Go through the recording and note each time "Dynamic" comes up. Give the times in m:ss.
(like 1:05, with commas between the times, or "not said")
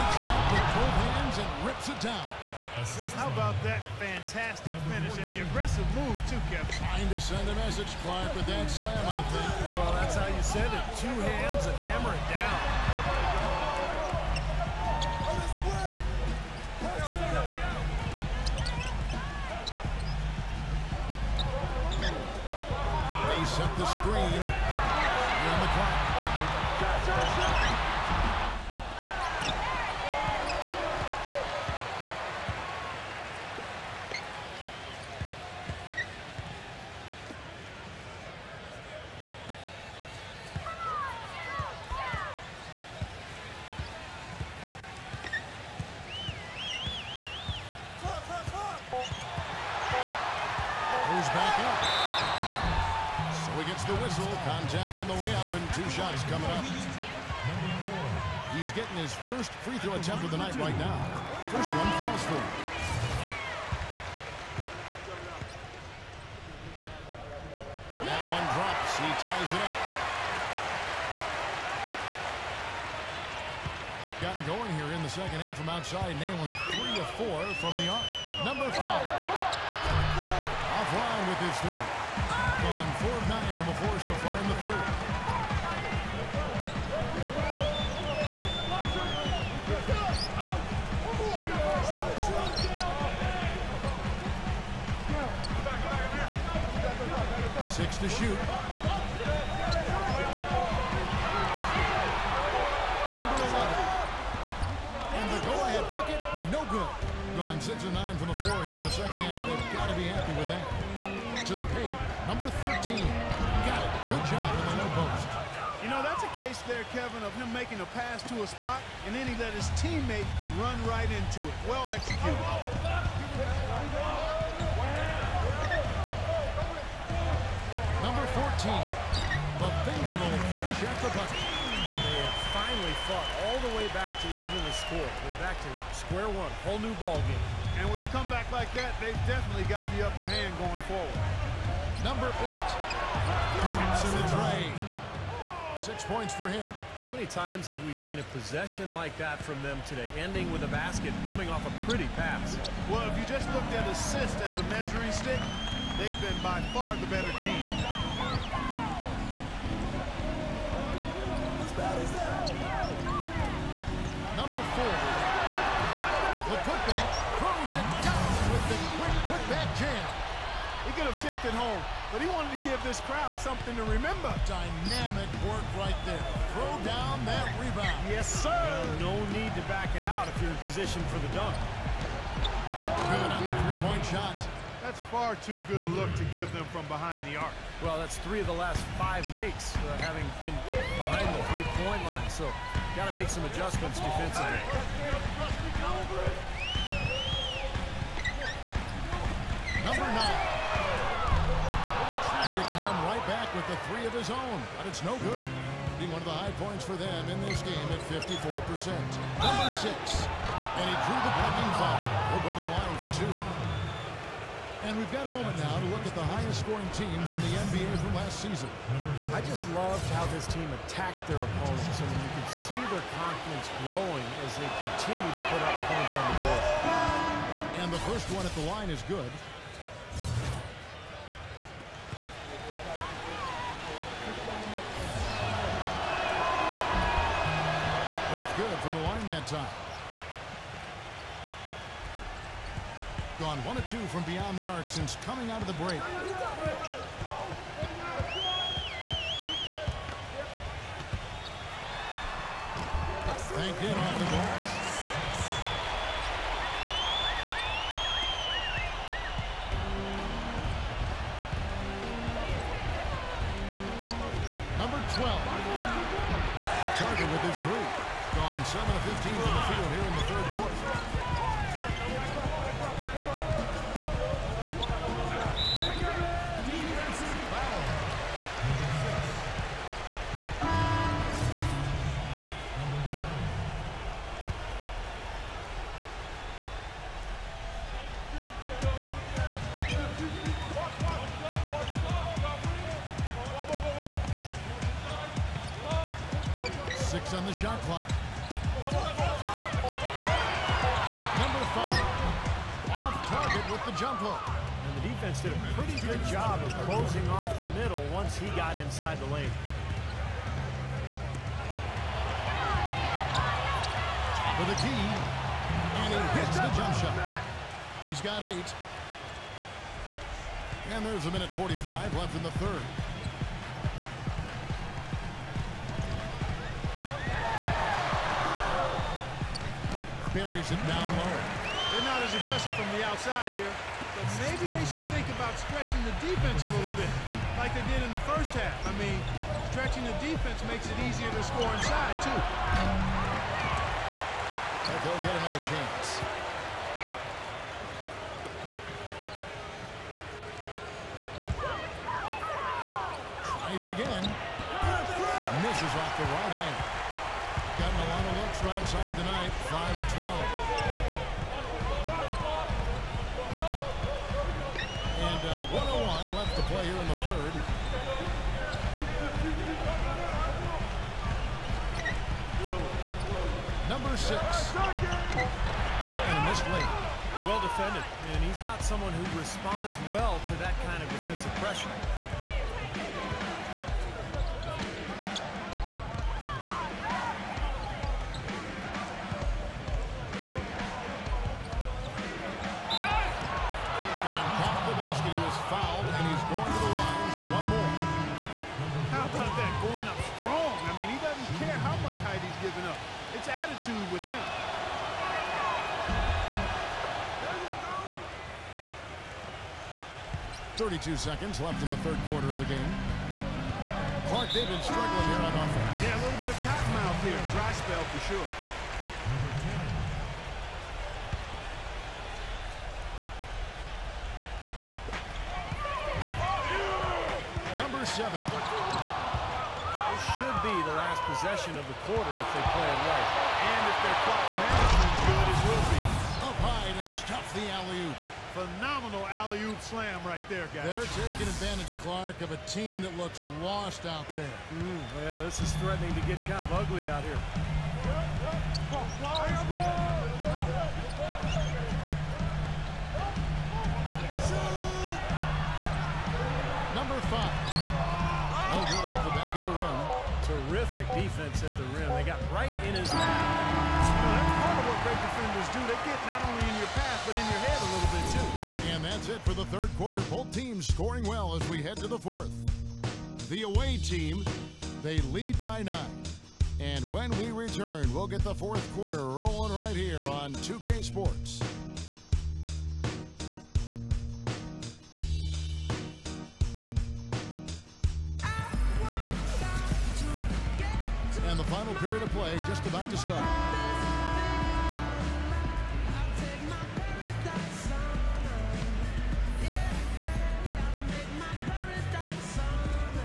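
2:54.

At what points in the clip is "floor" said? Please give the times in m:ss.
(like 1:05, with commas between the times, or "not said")
1:48.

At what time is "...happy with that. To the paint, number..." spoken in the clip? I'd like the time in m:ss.
1:50.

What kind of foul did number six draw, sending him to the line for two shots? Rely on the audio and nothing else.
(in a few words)
Blocking foul.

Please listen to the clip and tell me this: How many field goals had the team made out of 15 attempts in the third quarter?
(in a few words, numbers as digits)
7.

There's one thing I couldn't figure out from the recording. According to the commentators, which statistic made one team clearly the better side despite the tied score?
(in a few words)
Assists.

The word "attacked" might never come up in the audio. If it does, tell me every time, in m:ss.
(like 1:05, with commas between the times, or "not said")
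3:40.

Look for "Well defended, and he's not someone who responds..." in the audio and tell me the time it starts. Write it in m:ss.
6:17.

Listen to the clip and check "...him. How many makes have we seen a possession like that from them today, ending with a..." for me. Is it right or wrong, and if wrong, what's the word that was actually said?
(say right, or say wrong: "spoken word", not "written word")
wrong: "times", not "makes".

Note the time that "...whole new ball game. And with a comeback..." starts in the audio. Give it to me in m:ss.
2:16.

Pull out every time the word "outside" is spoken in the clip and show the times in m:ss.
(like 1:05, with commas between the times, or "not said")
1:15, 5:33, 5:58.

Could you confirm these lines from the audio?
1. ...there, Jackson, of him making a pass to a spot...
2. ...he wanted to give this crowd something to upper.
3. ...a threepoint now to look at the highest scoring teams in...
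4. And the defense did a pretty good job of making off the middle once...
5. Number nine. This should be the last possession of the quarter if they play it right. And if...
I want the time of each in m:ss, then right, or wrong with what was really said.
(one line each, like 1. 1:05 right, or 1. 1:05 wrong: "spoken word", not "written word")
1. 1:56 wrong: "Kevin", not "Jackson"
2. 2:52 wrong: "remember", not "upper"
3. 3:35 wrong: "moment", not "threepoint"
4. 5:04 wrong: "closing", not "making"
5. 7:07 wrong: "seven", not "nine".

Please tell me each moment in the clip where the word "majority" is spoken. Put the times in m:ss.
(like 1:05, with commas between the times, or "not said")
not said.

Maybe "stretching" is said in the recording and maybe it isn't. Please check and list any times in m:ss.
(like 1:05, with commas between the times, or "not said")
5:35, 5:39.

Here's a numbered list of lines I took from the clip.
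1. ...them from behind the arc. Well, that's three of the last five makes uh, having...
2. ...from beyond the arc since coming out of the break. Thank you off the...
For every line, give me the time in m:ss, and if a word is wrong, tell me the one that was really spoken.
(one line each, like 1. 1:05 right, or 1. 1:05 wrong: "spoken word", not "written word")
1. 3:06 right
2. 4:04 right.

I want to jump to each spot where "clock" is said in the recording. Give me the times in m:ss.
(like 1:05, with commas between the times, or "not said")
0:25, 4:57, 7:14.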